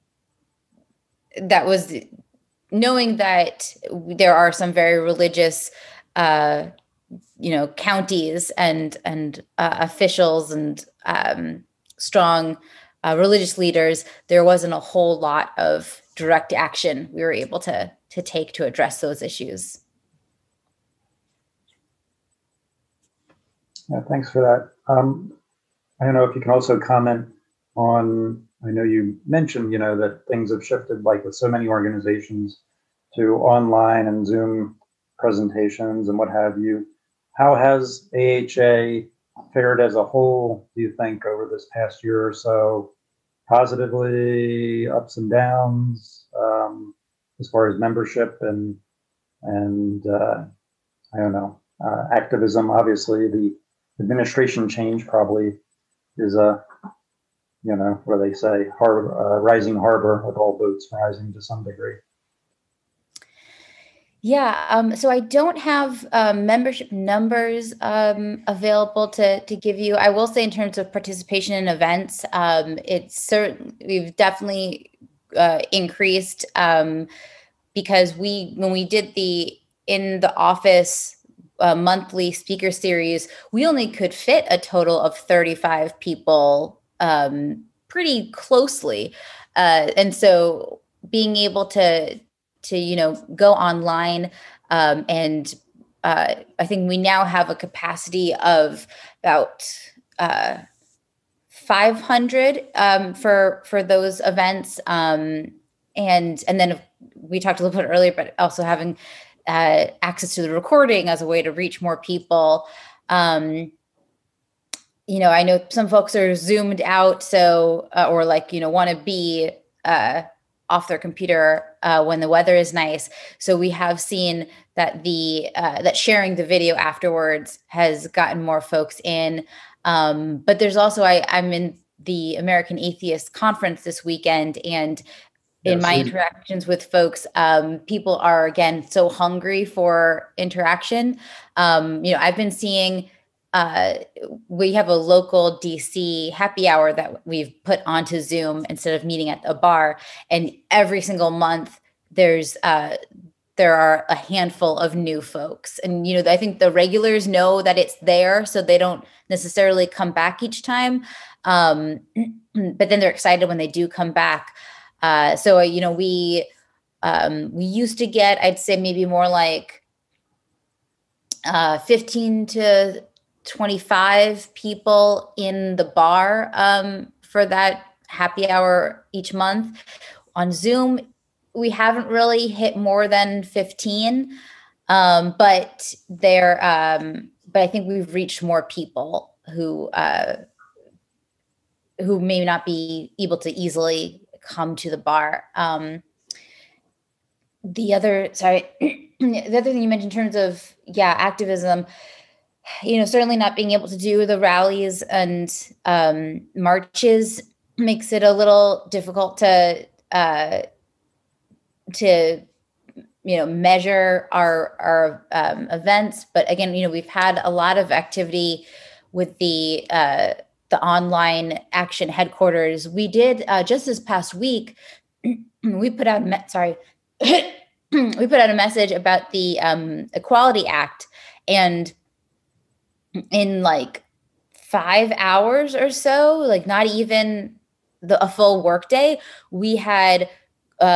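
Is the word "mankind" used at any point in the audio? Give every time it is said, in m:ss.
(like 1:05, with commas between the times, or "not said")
not said.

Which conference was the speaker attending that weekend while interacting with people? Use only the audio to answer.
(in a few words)
American Atheist Conference.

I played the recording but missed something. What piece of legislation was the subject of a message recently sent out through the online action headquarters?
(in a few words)
Equality Act.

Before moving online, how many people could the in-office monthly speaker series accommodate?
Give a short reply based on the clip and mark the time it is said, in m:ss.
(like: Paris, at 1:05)
35, at 1:25.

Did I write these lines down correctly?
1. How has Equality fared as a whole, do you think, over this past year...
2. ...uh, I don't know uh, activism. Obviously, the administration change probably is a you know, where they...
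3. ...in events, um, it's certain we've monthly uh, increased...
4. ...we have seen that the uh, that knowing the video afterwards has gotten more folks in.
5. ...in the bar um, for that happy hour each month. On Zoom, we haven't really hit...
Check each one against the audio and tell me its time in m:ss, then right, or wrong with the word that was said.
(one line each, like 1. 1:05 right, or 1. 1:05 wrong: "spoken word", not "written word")
1. 0:37 wrong: "AHA", not "Equality"
2. 0:50 right
3. 1:11 wrong: "definitely", not "monthly"
4. 2:03 wrong: "sharing", not "knowing"
5. 2:55 right.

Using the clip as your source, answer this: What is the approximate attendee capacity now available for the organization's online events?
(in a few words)
500.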